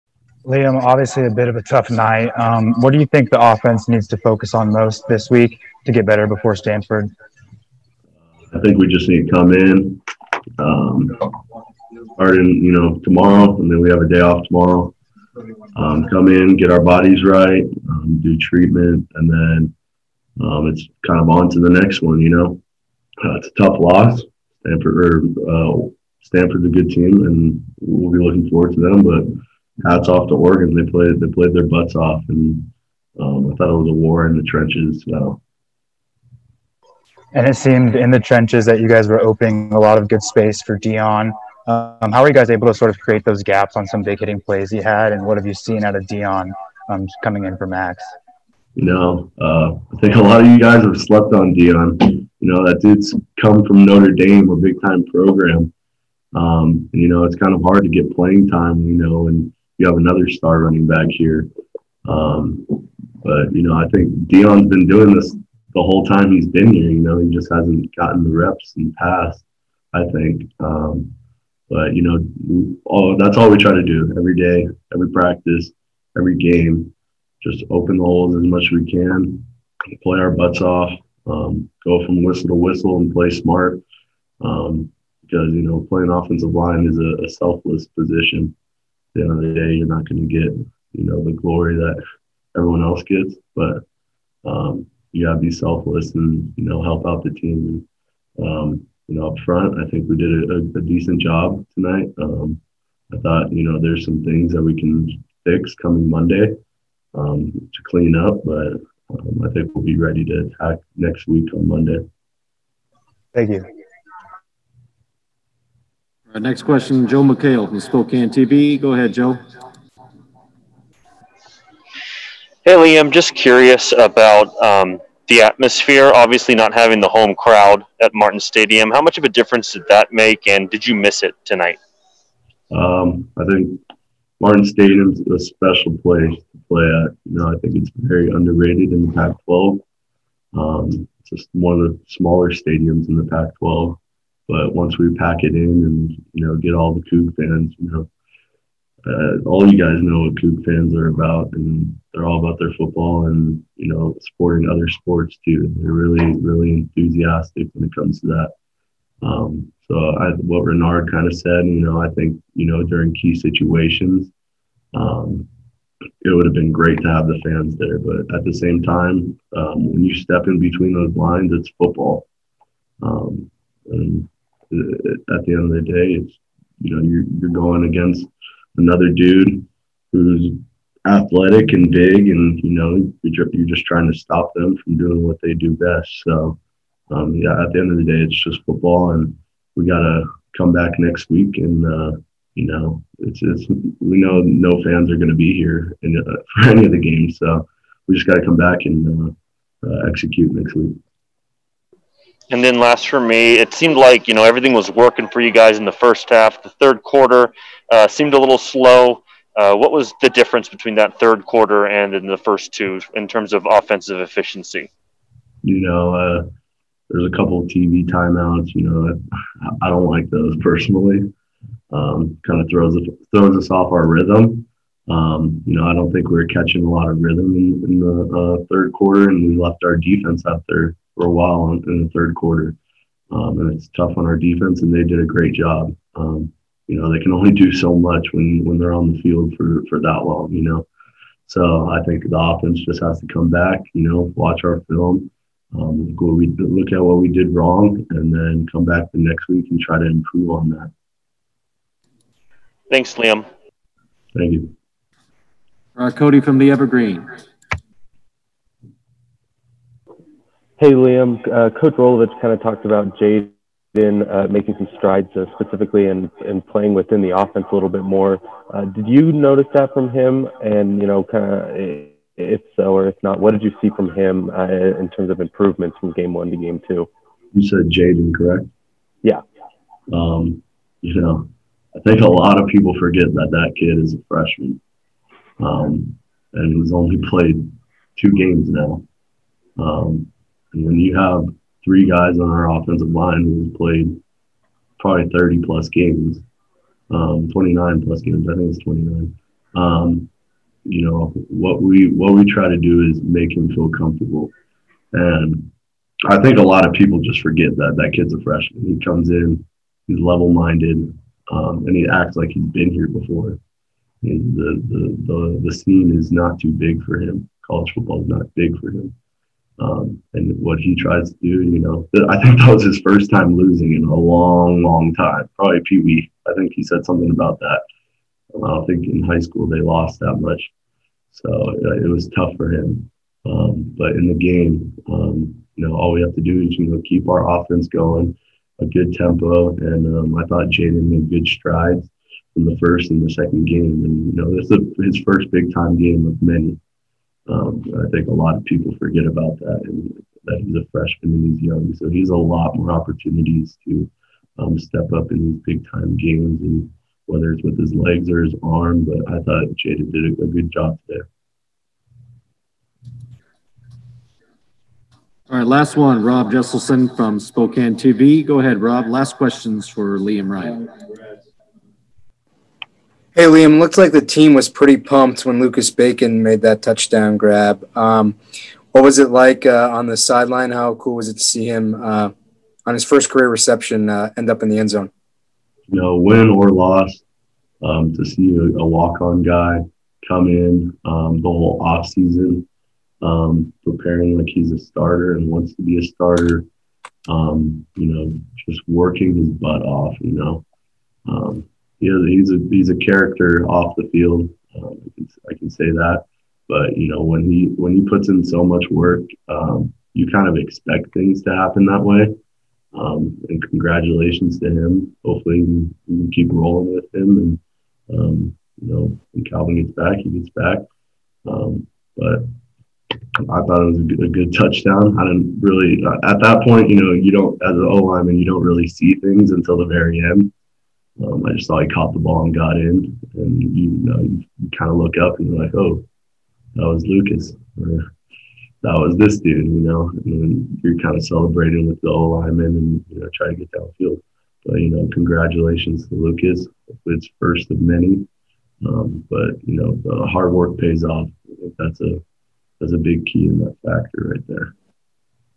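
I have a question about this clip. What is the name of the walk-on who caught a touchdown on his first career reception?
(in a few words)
Lucas Bacon.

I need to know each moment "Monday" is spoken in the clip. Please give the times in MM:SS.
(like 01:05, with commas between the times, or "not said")
01:46, 01:51.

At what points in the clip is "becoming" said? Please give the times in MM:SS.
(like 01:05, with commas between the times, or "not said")
not said.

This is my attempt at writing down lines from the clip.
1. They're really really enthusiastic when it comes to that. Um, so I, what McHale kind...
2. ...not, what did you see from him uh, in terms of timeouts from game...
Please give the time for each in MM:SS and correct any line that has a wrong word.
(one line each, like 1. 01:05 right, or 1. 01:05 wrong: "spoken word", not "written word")
1. 02:35 wrong: "Renard", not "McHale"
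2. 04:33 wrong: "improvements", not "timeouts".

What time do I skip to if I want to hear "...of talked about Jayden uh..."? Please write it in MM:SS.
04:22.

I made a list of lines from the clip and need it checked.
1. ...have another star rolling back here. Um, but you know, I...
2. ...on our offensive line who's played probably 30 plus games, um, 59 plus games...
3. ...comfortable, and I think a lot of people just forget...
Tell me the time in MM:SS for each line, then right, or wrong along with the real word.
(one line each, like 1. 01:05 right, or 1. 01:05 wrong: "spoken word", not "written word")
1. 00:59 wrong: "running", not "rolling"
2. 04:52 wrong: "29", not "59"
3. 05:03 right.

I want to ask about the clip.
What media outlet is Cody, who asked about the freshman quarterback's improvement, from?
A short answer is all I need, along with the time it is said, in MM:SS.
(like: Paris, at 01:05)
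the Evergreen, at 04:16.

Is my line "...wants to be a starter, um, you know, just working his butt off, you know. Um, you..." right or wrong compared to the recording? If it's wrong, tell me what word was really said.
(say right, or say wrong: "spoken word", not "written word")
right.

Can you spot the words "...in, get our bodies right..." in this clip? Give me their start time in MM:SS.
00:16.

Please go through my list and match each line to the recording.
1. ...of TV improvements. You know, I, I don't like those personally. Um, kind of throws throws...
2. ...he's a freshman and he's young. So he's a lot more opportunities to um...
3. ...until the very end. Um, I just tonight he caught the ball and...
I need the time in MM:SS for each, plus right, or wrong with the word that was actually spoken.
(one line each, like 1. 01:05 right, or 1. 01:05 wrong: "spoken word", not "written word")
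1. 03:37 wrong: "timeouts", not "improvements"
2. 05:50 right
3. 07:09 wrong: "thought", not "tonight".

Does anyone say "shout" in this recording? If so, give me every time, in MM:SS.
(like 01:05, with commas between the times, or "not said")
not said.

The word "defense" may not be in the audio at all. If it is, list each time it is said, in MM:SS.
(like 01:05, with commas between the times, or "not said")
03:49, 03:54.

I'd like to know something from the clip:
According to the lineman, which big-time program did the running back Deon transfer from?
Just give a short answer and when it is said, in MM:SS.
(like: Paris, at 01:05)
Notre Dame, at 00:53.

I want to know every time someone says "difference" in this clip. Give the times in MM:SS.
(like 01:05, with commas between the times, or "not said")
02:09, 03:30.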